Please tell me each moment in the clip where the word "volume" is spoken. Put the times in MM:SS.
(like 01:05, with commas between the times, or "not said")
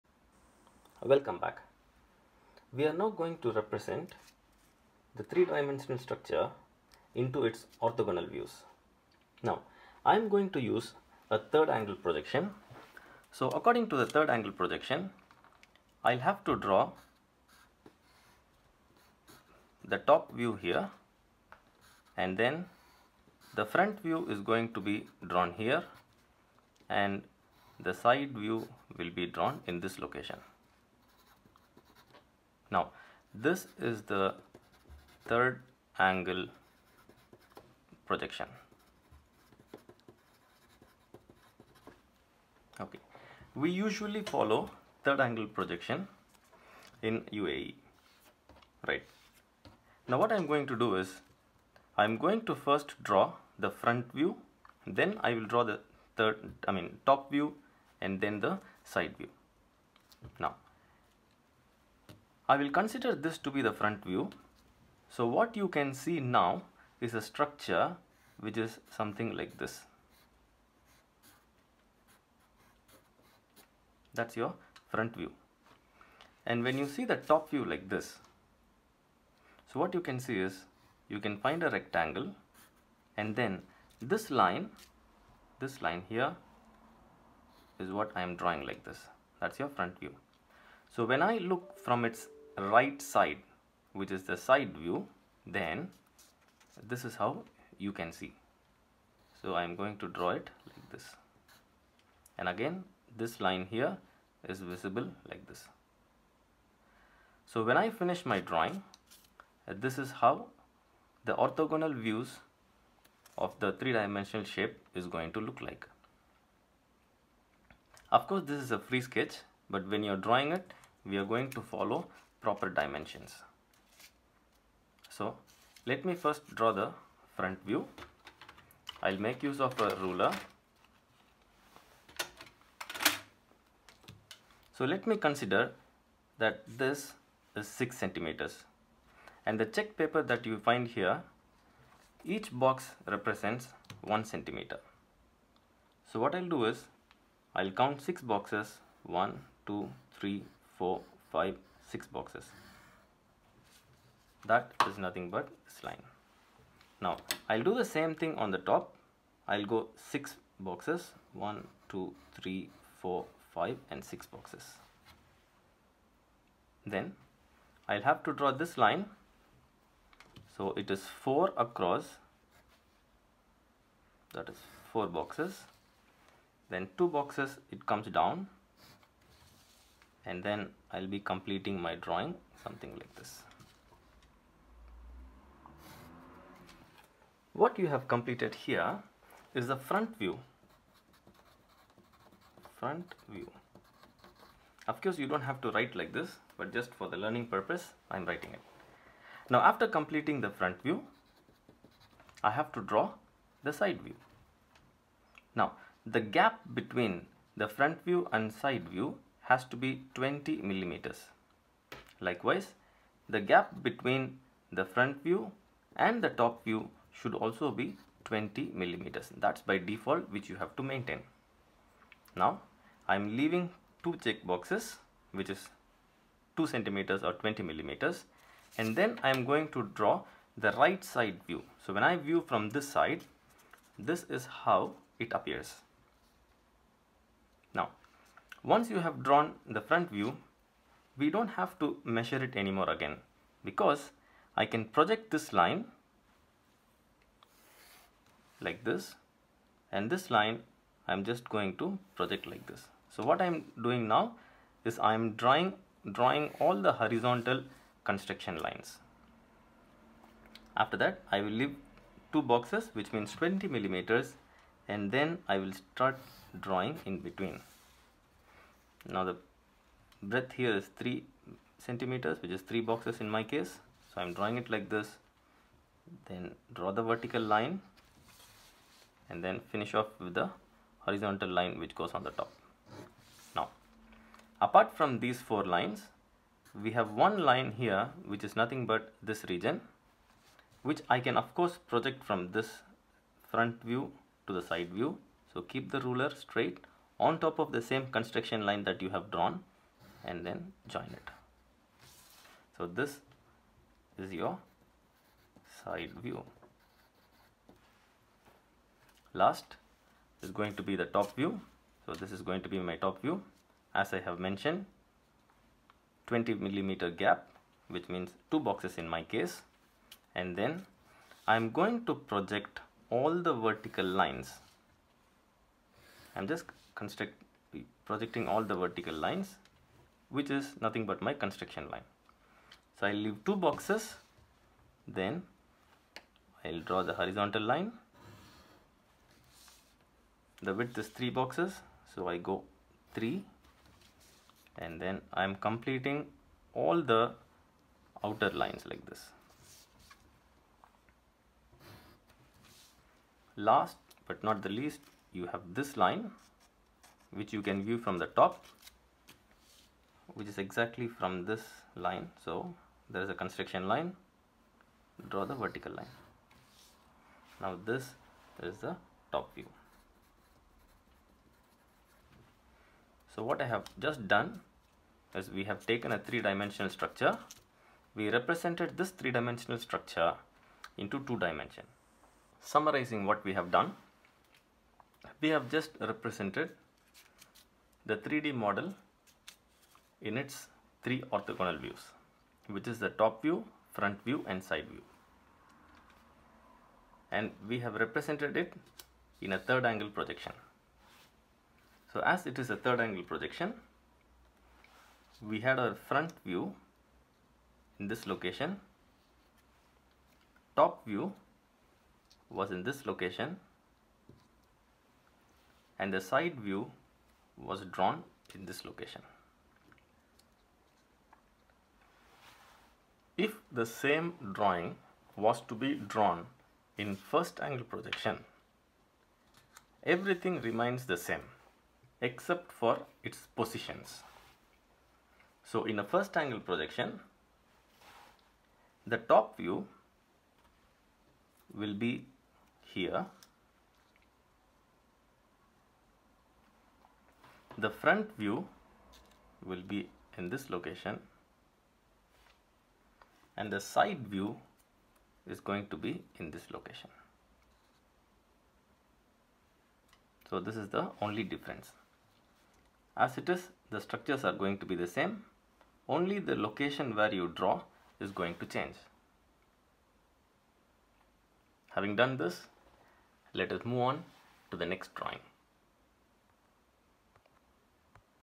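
not said.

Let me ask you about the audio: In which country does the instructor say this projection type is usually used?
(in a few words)
UAE.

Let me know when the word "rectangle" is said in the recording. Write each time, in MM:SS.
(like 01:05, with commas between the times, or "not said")
01:21.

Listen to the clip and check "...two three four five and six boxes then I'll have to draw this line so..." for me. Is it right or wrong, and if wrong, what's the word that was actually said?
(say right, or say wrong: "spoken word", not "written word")
right.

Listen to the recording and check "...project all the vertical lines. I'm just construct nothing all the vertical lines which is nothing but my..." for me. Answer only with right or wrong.
wrong.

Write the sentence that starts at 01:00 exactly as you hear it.
Now I will consider this to be the front view.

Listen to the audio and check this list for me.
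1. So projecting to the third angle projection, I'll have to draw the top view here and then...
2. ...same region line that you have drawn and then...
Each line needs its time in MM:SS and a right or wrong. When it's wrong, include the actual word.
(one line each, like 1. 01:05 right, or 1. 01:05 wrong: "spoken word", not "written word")
1. 00:13 wrong: "according", not "projecting"
2. 04:57 wrong: "construction", not "region".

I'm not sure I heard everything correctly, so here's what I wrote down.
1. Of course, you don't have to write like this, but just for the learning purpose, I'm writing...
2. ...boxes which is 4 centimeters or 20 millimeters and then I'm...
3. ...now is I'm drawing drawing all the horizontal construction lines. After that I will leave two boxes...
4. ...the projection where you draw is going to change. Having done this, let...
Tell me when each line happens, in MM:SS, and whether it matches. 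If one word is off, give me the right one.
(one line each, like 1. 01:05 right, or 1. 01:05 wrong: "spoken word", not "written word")
1. 03:14 right
2. 03:44 wrong: "2", not "4"
3. 04:14 right
4. 07:46 wrong: "location", not "projection".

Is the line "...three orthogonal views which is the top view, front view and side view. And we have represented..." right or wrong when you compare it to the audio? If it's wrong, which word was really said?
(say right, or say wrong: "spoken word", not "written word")
right.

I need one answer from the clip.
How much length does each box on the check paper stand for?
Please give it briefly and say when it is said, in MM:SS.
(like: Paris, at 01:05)
1 centimeter, at 02:24.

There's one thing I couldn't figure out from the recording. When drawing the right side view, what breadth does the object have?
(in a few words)
3 centimeters.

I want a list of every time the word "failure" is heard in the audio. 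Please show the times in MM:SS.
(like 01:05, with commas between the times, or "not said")
not said.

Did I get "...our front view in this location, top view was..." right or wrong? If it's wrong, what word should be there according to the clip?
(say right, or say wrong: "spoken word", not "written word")
right.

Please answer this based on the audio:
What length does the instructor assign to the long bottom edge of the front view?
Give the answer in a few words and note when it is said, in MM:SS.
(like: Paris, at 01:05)
6 centimeters, at 02:17.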